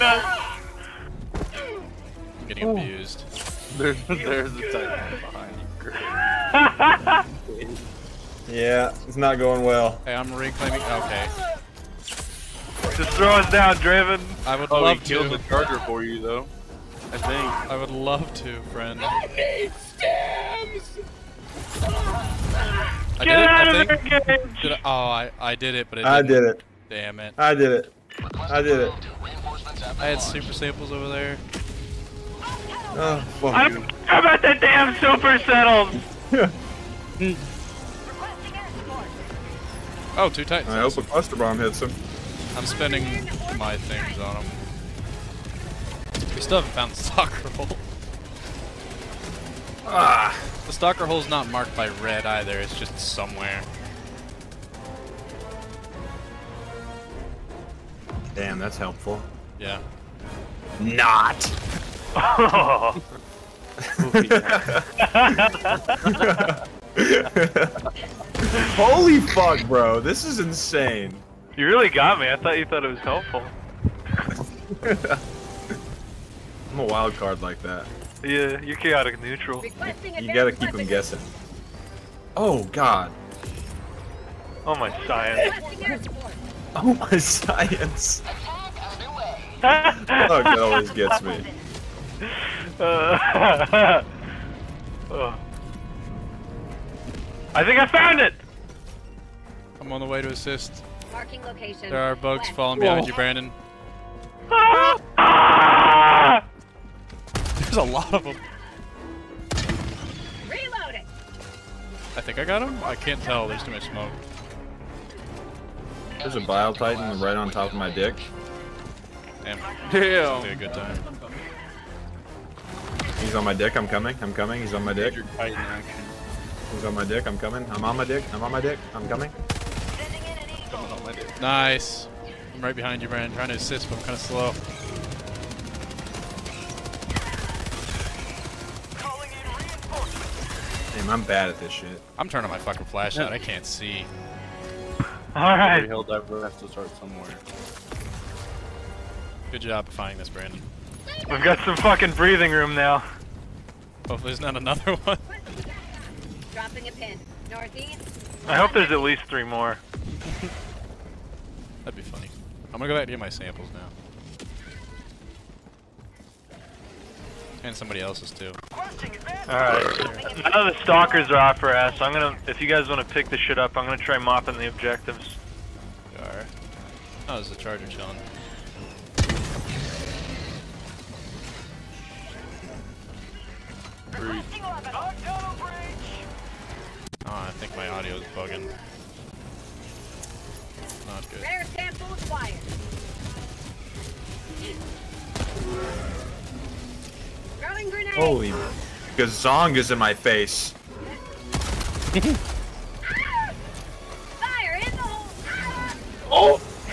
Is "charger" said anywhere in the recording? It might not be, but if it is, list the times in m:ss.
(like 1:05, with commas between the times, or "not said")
0:15, 2:57.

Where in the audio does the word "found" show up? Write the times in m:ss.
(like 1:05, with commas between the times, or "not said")
0:46, 1:37.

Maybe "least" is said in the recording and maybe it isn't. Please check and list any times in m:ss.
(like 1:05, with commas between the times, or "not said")
2:38.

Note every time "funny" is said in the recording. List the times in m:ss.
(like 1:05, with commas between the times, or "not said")
2:42.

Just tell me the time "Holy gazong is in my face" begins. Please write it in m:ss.
3:18.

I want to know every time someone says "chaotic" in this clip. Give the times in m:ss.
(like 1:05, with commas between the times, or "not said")
1:18.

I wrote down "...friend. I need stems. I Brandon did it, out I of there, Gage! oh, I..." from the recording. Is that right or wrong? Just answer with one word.
wrong.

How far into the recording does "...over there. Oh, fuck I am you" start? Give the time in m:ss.
0:30.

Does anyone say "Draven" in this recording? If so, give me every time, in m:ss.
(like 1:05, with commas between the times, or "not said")
0:13.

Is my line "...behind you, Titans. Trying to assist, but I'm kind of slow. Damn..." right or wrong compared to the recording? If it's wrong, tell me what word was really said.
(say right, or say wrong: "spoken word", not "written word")
wrong: "Brandon", not "Titans".